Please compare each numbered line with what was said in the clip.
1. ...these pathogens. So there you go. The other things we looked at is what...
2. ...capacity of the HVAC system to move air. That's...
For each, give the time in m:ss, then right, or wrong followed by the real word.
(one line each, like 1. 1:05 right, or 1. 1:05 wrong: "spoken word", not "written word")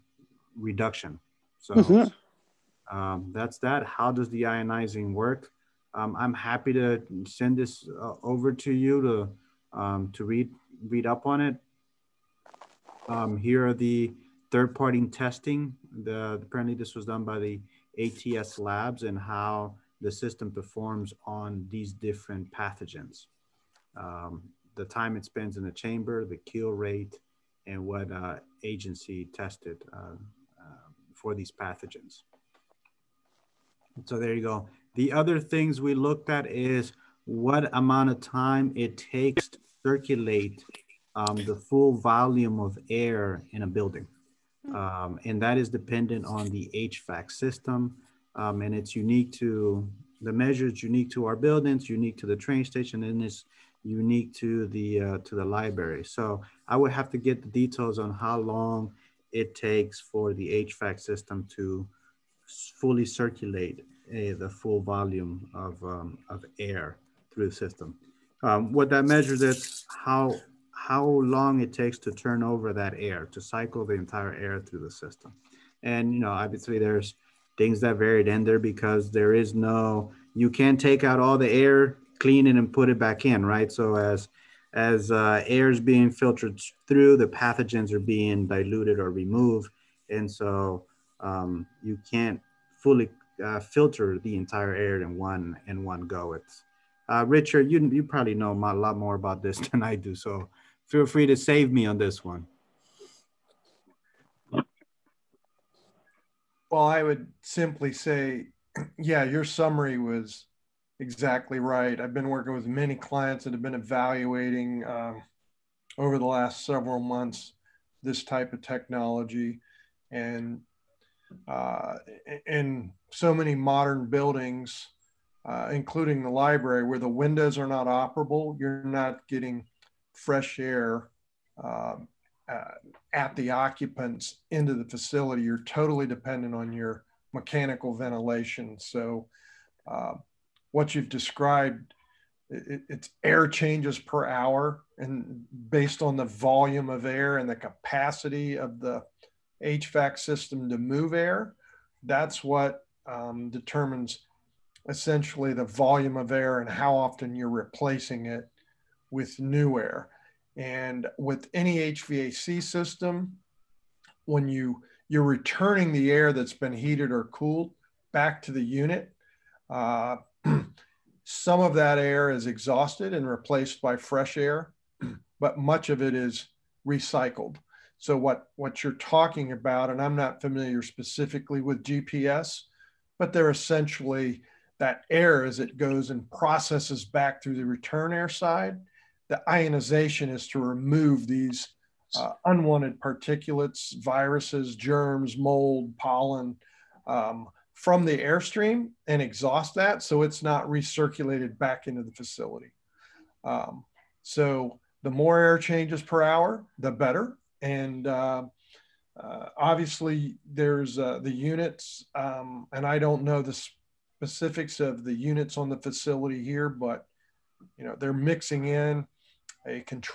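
1. 0:31 right
2. 2:27 right.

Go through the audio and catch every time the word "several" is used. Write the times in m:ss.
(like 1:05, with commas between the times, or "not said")
1:56.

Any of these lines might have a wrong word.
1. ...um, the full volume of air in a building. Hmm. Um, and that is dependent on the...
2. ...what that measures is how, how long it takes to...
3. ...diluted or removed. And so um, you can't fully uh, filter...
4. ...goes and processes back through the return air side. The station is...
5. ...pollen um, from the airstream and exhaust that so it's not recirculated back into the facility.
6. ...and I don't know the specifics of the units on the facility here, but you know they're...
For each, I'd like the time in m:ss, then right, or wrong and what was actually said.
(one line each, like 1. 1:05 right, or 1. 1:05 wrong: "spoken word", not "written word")
1. 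0:41 right
2. 1:08 right
3. 1:28 right
4. 3:05 wrong: "ionization", not "station"
5. 3:15 right
6. 3:32 right.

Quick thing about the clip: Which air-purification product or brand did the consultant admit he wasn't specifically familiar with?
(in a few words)
GPS.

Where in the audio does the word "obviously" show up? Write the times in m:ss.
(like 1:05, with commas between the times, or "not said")
1:16, 3:29.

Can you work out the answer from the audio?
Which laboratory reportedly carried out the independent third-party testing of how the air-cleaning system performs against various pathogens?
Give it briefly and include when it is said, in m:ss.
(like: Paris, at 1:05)
ATS labs, at 0:18.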